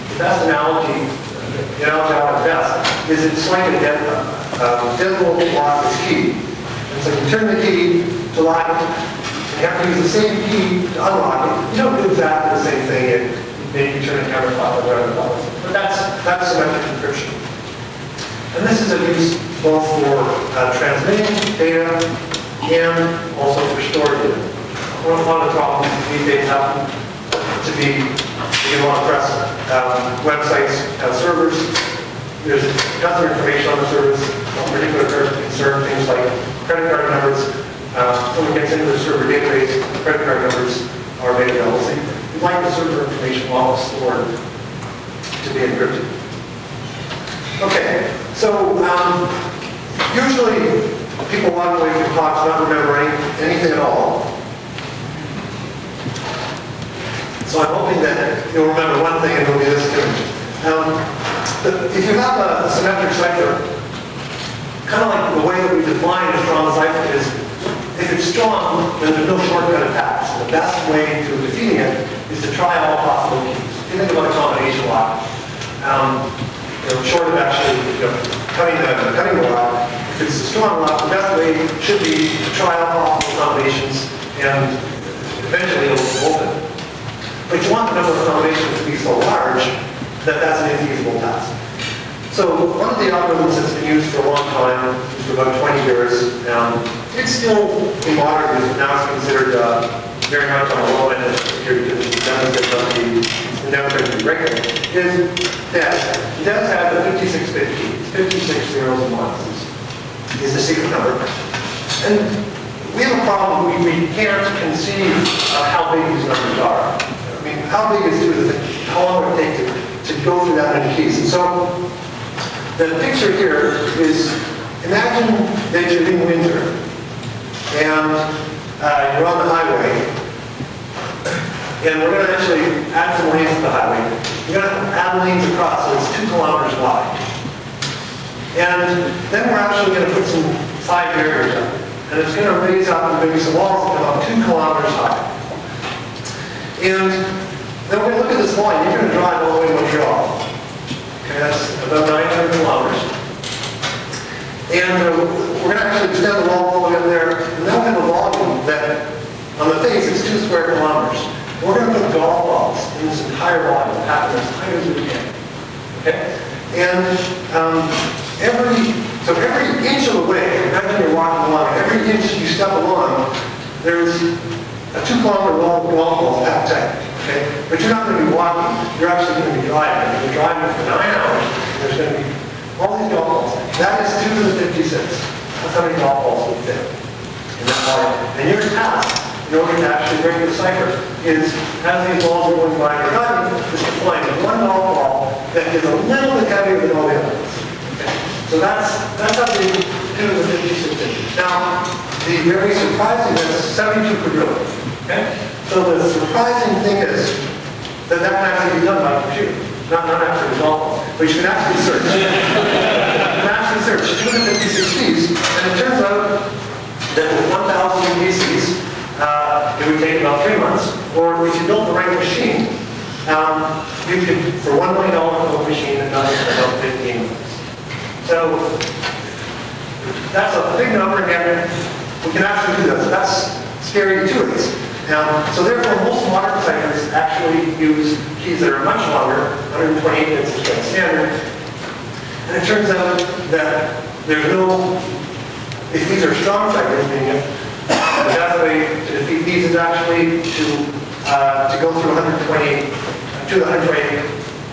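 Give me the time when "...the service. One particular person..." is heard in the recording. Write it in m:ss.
0:33.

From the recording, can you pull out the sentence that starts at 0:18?
And this is a use both for uh, transmitting data and also for storing data.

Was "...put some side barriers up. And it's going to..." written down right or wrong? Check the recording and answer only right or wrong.
right.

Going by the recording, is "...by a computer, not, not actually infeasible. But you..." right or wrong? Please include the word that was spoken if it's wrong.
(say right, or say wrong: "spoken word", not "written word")
wrong: "resolvable", not "infeasible".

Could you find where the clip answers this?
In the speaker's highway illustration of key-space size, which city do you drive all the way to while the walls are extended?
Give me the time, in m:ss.
2:29.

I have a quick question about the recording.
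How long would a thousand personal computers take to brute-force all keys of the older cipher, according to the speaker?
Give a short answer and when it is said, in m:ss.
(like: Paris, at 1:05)
3 months, at 3:40.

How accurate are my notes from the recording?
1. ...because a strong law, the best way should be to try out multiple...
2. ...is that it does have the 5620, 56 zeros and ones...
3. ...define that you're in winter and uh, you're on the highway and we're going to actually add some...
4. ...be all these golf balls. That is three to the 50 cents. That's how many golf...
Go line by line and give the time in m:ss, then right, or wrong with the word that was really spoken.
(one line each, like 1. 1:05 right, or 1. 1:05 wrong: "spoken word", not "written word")
1. 1:20 right
2. 1:44 wrong: "5650", not "5620"
3. 2:04 wrong: "imagine", not "define"
4. 3:02 wrong: "two", not "three".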